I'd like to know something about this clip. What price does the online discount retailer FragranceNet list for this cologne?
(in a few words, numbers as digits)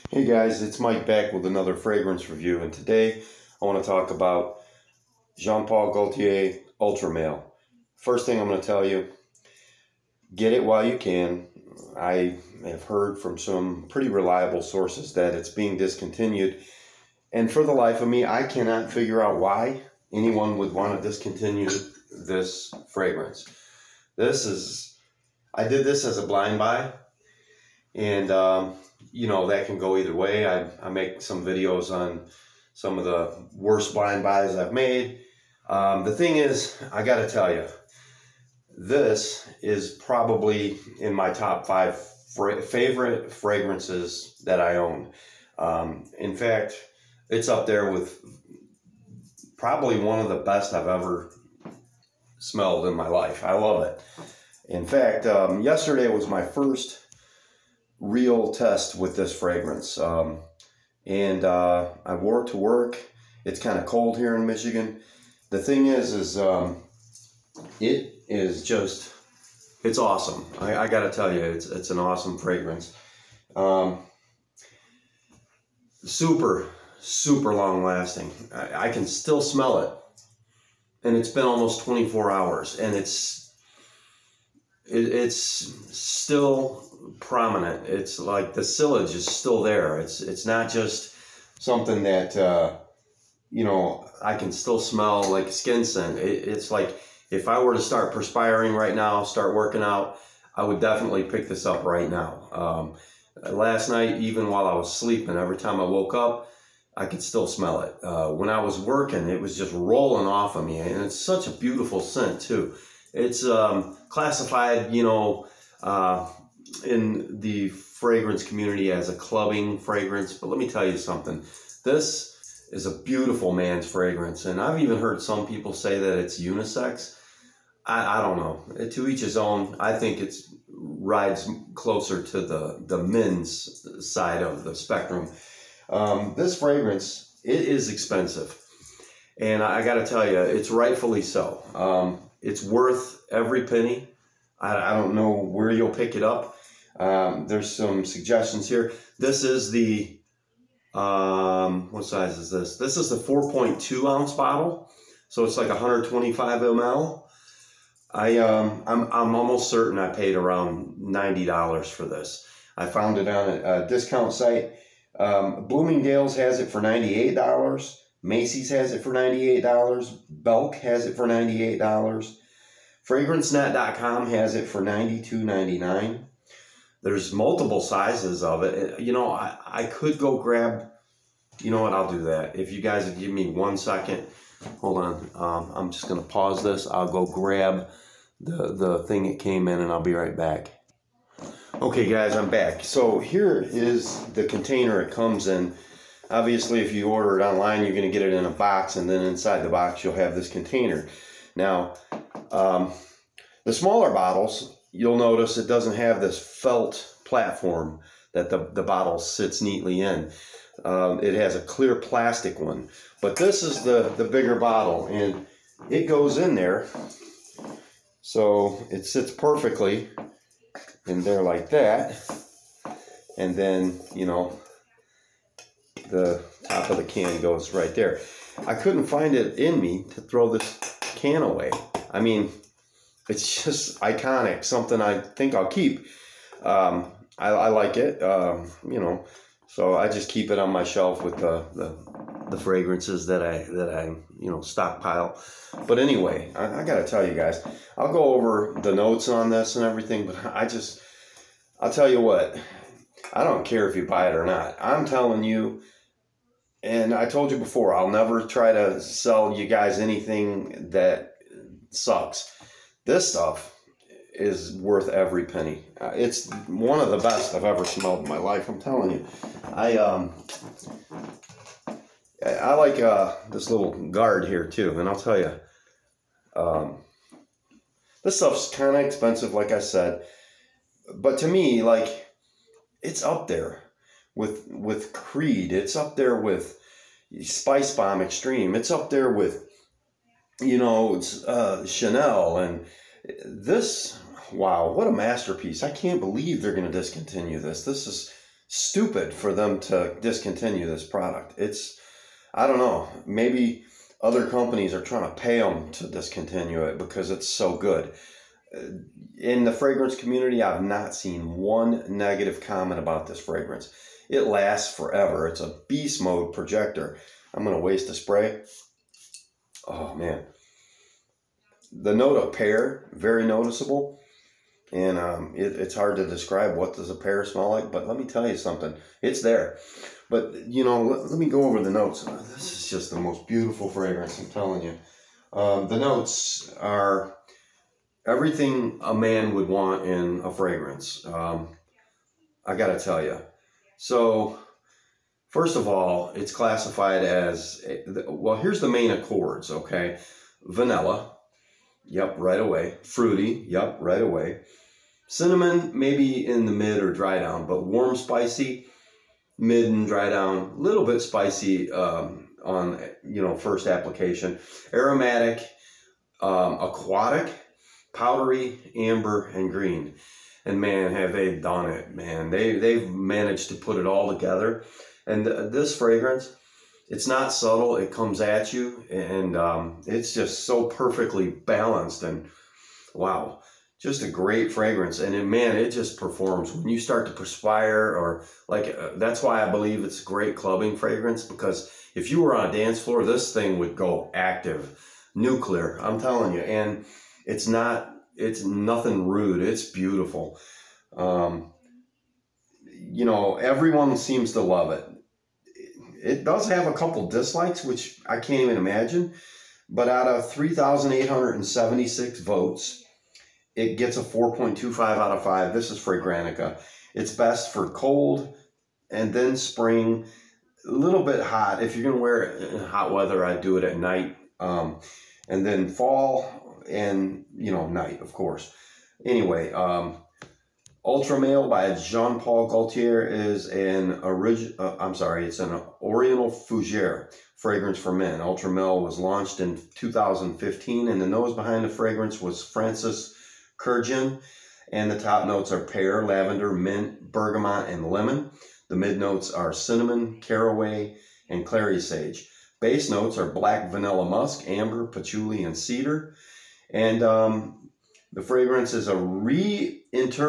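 $92.99.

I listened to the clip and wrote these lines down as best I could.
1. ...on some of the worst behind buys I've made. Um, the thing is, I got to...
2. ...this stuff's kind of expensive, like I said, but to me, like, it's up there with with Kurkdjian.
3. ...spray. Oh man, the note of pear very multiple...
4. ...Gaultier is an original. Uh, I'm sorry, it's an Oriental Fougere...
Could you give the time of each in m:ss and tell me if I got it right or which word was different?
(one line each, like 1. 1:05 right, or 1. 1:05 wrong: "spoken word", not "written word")
1. 0:31 wrong: "blind", not "behind"
2. 4:38 wrong: "Creed", not "Kurkdjian"
3. 5:18 wrong: "noticeable", not "multiple"
4. 7:12 right.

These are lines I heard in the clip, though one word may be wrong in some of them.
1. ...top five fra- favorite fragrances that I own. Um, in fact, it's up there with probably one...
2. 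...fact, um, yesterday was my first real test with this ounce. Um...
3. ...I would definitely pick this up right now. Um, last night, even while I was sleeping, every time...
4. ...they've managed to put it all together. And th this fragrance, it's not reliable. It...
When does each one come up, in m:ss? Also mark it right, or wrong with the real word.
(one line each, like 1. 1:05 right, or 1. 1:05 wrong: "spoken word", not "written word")
1. 0:41 right
2. 0:54 wrong: "fragrance", not "ounce"
3. 1:40 right
4. 6:12 wrong: "subtle", not "reliable".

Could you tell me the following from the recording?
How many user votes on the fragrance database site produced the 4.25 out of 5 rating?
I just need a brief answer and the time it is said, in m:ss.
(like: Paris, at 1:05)
3,876, at 6:50.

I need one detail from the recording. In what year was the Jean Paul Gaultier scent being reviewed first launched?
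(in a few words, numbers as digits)
2015.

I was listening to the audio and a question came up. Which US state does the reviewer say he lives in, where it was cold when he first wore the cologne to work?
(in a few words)
Michigan.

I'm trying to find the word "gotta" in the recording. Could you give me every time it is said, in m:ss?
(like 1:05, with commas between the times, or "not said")
5:42.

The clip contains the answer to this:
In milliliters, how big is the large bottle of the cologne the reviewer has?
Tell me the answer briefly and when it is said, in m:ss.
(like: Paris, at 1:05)
125 ml, at 2:35.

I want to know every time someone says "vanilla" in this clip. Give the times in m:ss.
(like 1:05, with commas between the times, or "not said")
5:50, 7:33.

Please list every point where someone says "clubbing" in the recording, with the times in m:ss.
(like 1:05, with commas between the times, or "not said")
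1:59, 6:30.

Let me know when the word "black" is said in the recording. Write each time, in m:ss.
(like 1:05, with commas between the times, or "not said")
7:33.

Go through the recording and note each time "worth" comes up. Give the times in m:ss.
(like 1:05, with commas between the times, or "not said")
2:22, 4:24.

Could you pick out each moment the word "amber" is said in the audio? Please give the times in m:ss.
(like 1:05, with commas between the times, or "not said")
6:08, 7:34.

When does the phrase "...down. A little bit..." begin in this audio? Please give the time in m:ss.
6:00.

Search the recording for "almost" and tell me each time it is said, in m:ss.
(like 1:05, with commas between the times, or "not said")
1:21, 2:39.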